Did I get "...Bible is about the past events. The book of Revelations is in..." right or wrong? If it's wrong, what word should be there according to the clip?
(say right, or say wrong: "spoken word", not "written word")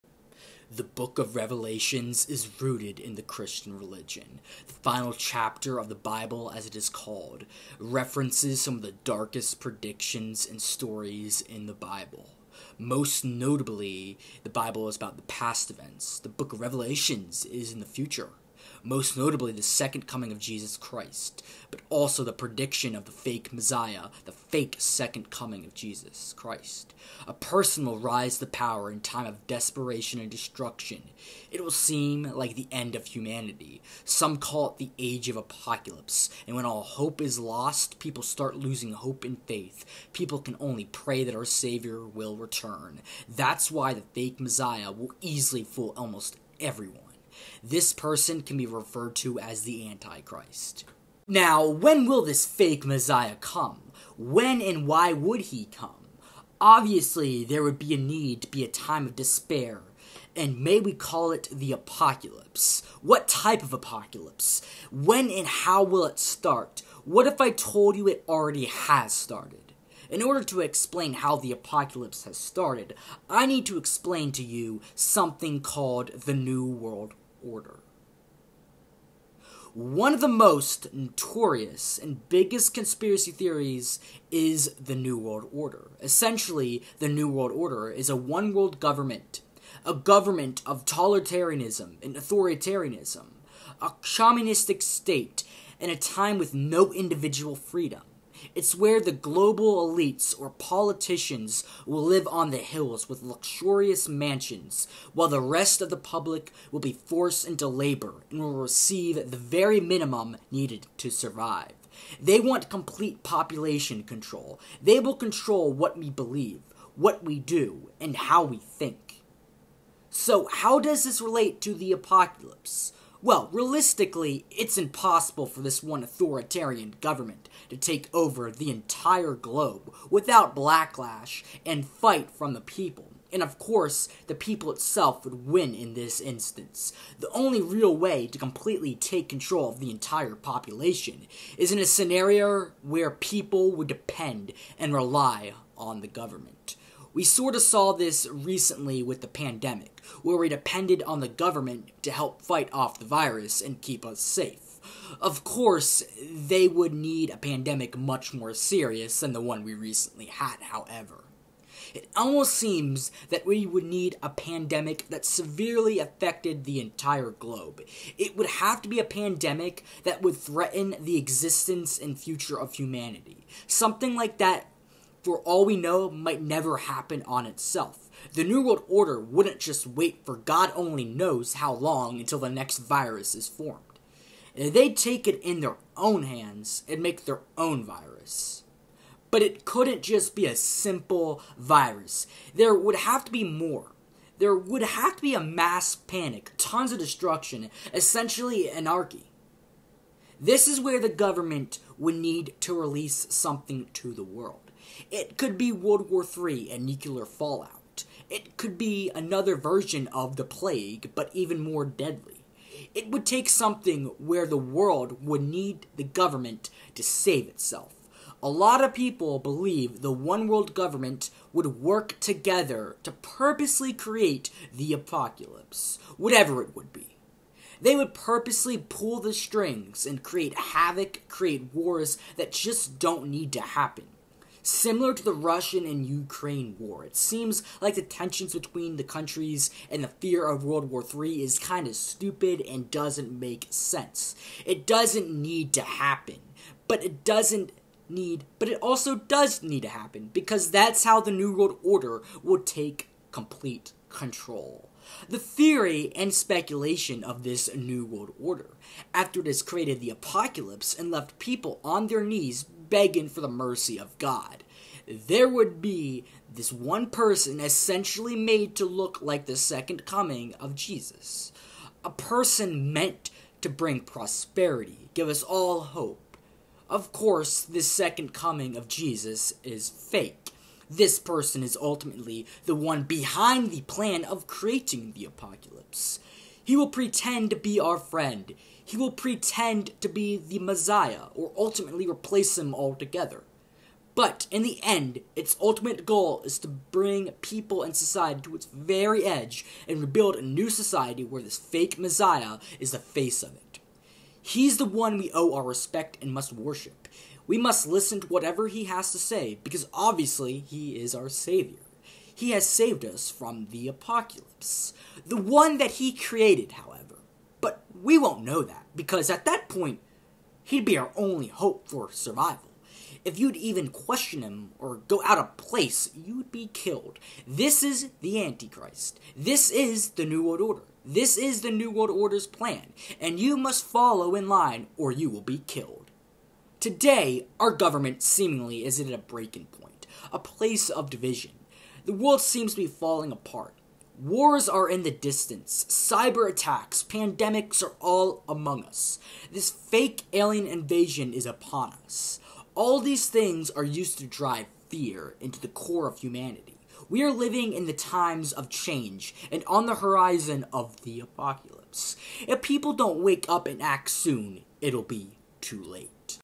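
right.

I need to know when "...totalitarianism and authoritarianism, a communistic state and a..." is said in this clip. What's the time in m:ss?
1:30.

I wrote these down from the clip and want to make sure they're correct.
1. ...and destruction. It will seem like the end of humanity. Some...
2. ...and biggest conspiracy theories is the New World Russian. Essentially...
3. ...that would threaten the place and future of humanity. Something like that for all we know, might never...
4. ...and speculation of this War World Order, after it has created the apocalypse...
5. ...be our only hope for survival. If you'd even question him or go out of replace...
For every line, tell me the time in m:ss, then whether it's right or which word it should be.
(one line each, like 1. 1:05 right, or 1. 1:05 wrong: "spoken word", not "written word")
1. 0:30 right
2. 1:21 wrong: "Order", not "Russian"
3. 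2:50 wrong: "existence", not "place"
4. 4:16 wrong: "New", not "War"
5. 5:20 wrong: "place", not "replace".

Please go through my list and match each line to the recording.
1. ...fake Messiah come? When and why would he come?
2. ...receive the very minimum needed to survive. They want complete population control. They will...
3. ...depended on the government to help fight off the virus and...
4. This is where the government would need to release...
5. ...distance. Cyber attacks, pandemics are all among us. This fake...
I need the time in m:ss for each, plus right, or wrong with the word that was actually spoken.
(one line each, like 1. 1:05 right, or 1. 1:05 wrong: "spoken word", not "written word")
1. 0:52 right
2. 1:48 right
3. 2:30 right
4. 3:20 right
5. 5:45 right.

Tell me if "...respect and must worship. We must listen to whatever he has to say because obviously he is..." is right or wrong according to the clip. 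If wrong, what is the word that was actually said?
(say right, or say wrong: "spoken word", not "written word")
right.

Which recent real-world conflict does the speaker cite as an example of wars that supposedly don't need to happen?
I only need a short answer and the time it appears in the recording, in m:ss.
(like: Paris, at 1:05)
Russian and Ukraine war, at 3:55.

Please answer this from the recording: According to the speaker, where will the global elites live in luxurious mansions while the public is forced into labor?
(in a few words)
On the hills.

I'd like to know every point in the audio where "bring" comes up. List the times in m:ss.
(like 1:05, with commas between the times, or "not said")
4:33, 4:56.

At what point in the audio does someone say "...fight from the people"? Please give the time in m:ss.
2:11.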